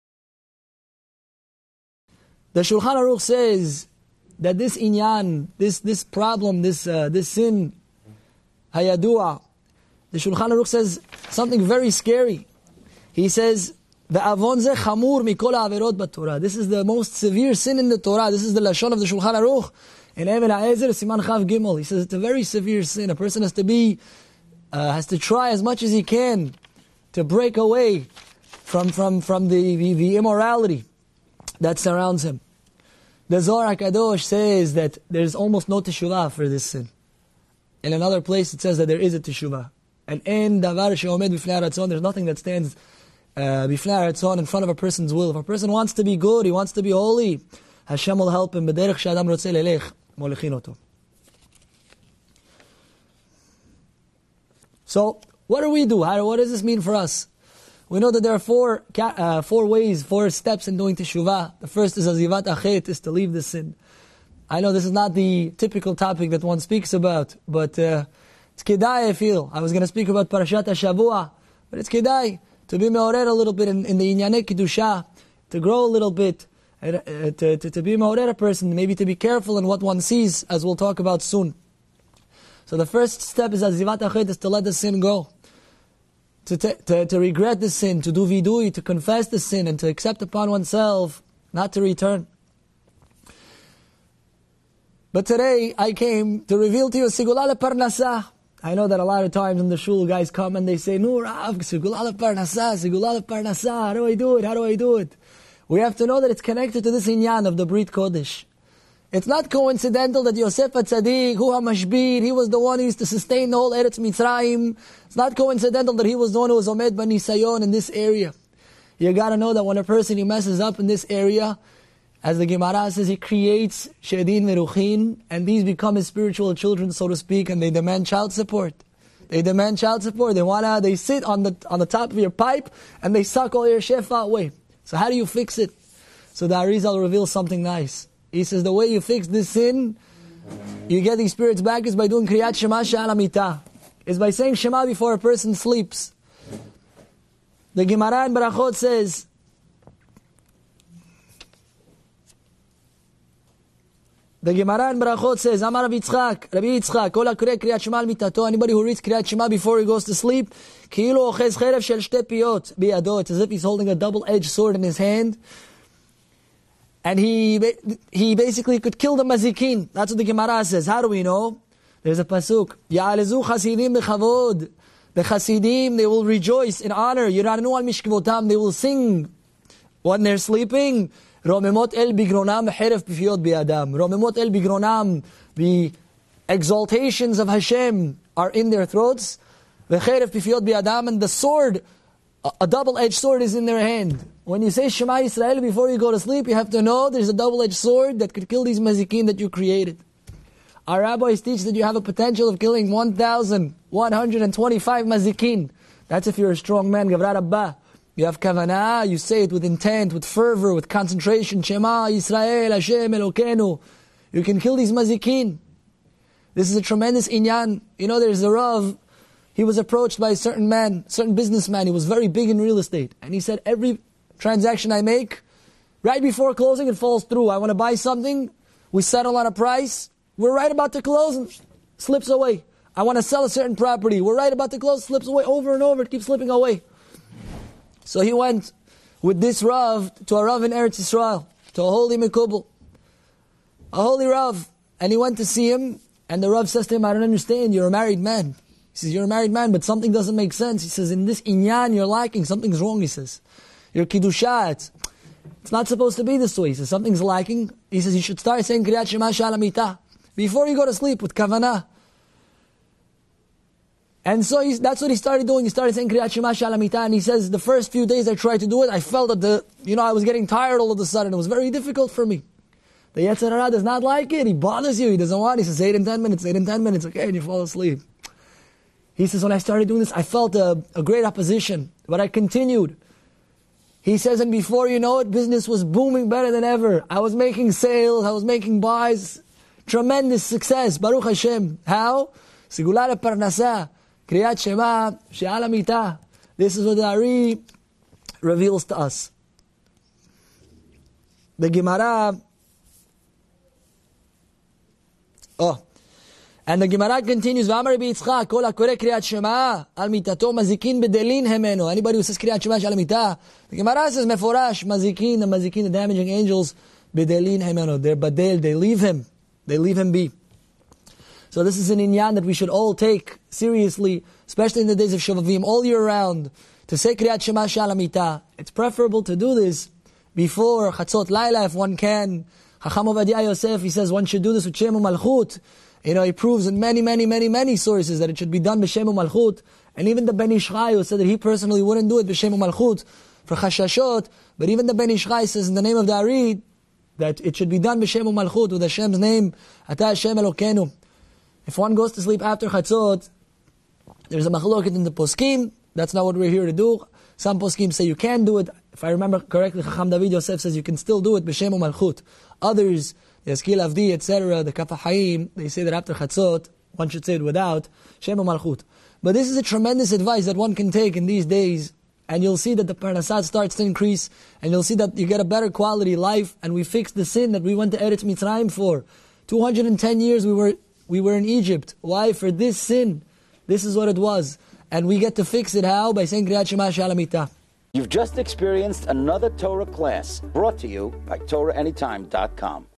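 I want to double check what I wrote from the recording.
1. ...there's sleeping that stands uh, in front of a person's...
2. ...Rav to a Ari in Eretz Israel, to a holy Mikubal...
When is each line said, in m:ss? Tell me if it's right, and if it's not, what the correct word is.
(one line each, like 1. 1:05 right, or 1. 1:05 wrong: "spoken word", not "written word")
1. 0:41 wrong: "nothing", not "sleeping"
2. 3:59 wrong: "Rav", not "Ari".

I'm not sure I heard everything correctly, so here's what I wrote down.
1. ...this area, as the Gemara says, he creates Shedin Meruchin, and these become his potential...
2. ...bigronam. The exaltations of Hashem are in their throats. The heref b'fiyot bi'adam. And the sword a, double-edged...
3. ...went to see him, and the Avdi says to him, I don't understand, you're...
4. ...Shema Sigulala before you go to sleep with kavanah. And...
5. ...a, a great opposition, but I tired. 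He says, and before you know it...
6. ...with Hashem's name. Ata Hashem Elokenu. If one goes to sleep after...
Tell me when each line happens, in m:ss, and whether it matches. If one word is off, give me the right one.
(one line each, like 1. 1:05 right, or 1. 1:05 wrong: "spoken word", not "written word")
1. 2:00 wrong: "spiritual", not "potential"
2. 3:04 right
3. 4:05 wrong: "Rav", not "Avdi"
4. 4:19 wrong: "Shalamita", not "Sigulala"
5. 4:40 wrong: "continued", not "tired"
6. 5:48 right.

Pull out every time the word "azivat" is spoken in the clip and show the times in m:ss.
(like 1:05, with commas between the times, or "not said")
1:02, 1:23.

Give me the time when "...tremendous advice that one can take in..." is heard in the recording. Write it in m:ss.
6:09.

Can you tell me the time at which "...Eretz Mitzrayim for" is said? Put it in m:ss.
6:17.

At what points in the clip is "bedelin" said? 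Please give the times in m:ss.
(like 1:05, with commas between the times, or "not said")
5:11, 5:17.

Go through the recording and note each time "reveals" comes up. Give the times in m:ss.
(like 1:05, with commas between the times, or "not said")
1:36, 2:17, 4:58.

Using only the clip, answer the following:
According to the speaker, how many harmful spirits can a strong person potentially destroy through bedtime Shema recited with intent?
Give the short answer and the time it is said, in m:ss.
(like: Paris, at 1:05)
1,125, at 3:22.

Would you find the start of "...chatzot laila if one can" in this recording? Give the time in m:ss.
5:30.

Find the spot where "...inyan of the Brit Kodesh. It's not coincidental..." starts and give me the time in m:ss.
1:47.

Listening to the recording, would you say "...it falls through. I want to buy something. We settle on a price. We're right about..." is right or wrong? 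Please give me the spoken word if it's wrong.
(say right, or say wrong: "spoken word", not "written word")
right.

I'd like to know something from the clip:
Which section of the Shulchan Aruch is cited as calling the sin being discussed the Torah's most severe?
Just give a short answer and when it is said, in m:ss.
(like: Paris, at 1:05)
Even Ha'ezer, at 0:20.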